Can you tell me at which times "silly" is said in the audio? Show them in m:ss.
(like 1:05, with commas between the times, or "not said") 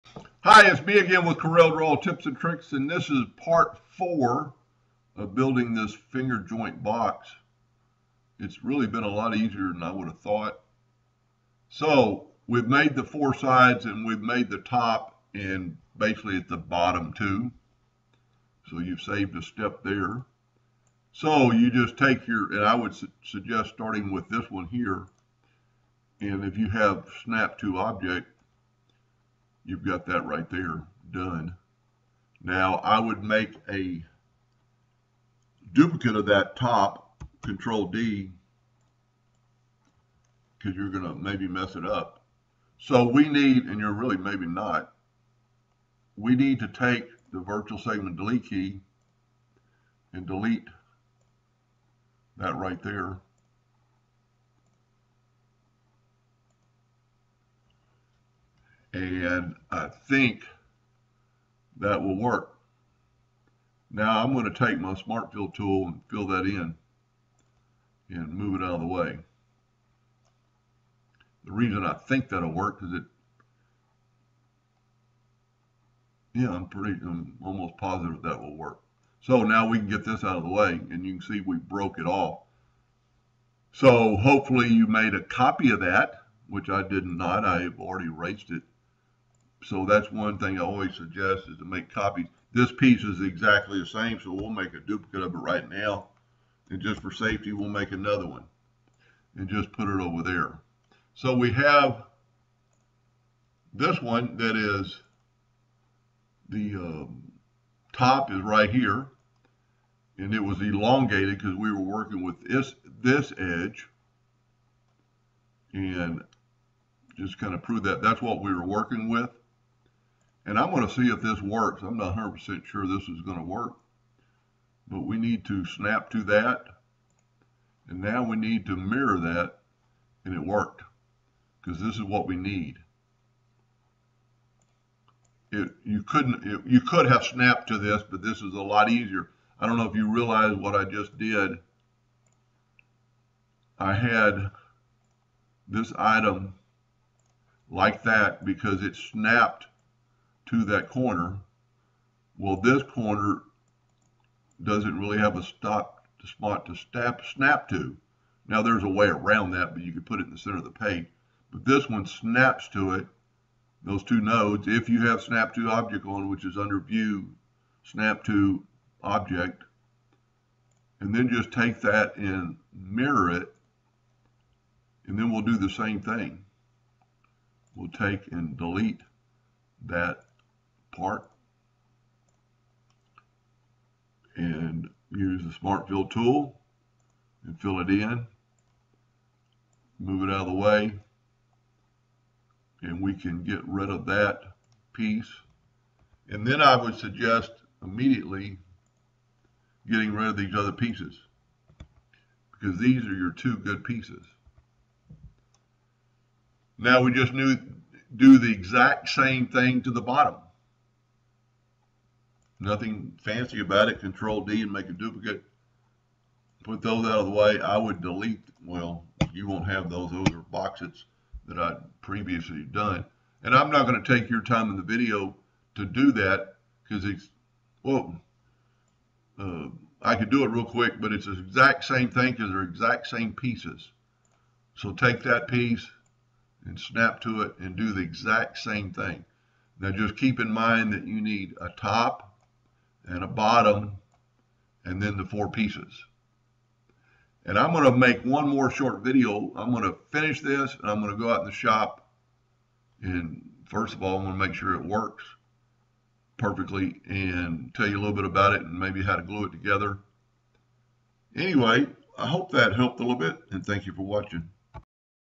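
not said.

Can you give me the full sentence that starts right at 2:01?
I'm not 100% sure this is going to work.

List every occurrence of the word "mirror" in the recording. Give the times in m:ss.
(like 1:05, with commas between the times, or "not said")
2:08, 2:52.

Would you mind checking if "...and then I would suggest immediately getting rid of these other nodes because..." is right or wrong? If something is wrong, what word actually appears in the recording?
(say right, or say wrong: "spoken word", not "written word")
wrong: "pieces", not "nodes".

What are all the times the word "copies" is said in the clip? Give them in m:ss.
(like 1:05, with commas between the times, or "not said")
1:31.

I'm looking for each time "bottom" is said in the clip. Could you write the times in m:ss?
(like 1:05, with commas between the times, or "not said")
0:16, 3:30, 4:03.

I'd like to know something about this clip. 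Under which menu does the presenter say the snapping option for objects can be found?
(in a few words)
View.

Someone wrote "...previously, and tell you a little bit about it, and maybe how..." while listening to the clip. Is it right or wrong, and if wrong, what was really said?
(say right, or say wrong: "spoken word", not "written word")
wrong: "perfectly", not "previously".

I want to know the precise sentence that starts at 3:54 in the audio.
So take that piece and snap to it and do the exact same thing.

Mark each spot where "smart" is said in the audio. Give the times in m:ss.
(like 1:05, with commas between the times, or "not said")
1:04, 3:05.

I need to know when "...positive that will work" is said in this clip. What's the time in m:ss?
1:17.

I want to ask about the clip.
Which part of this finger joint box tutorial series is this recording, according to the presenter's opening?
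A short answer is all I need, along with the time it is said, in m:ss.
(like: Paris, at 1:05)
Part 4, at 0:03.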